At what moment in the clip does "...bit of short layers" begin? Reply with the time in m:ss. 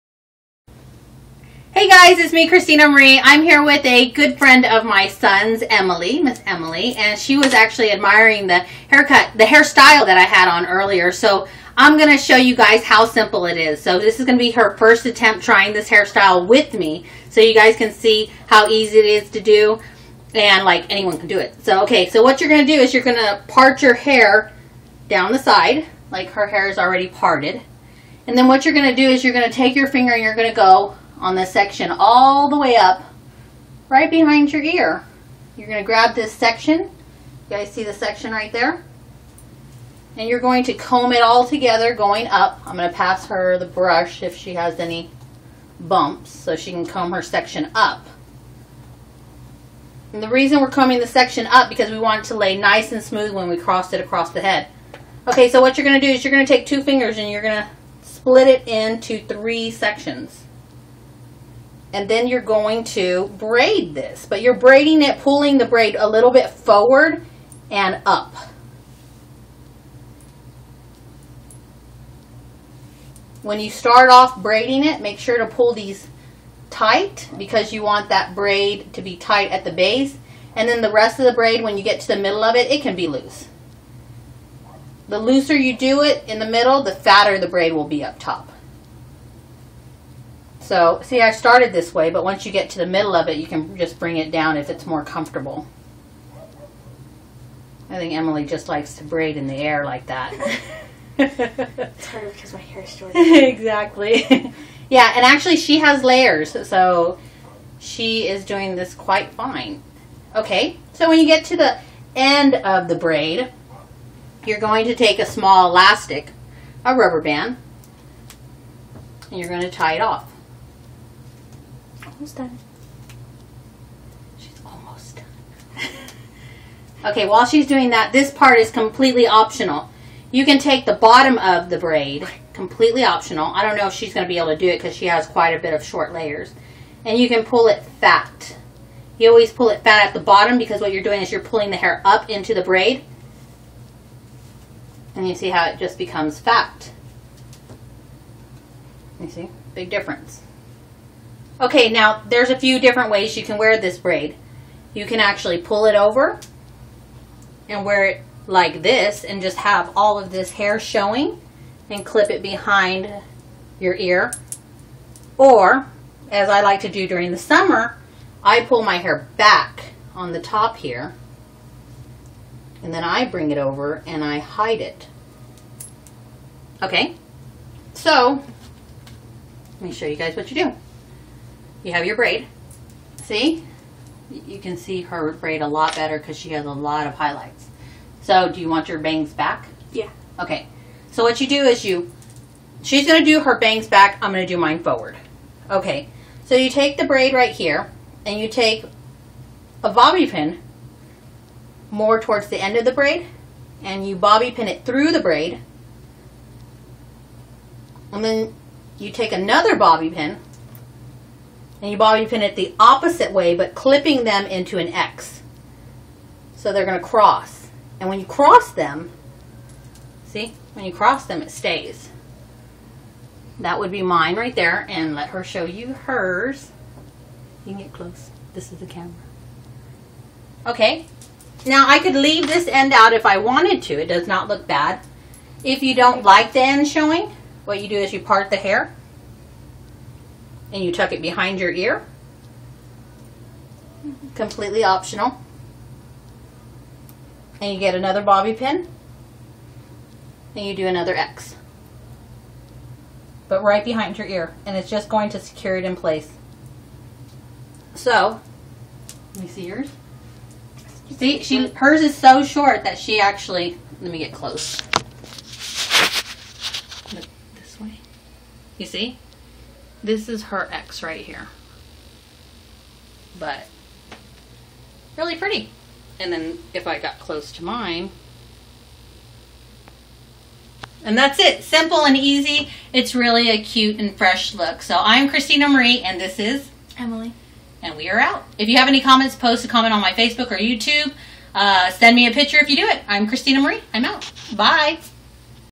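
2:15.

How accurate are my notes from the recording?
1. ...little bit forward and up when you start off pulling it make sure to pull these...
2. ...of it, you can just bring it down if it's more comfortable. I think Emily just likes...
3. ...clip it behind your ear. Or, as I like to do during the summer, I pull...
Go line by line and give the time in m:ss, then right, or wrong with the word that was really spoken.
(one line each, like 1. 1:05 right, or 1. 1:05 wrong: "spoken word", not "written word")
1. 1:06 wrong: "braiding", not "pulling"
2. 1:33 right
3. 2:42 right.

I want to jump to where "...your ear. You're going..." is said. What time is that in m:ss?
0:34.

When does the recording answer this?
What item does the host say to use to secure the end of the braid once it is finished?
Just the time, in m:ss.
1:55.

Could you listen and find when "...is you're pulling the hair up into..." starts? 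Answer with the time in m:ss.
2:21.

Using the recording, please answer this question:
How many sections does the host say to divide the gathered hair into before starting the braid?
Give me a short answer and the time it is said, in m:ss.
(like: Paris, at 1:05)
3, at 0:59.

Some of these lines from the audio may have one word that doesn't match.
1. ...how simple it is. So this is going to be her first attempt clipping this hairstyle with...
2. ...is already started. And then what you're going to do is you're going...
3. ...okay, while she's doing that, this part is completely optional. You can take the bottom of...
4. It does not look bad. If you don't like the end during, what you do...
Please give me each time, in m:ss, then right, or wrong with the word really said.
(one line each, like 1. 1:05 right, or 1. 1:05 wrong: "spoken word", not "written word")
1. 0:12 wrong: "trying", not "clipping"
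2. 0:26 wrong: "parted", not "started"
3. 2:07 right
4. 3:53 wrong: "showing", not "during".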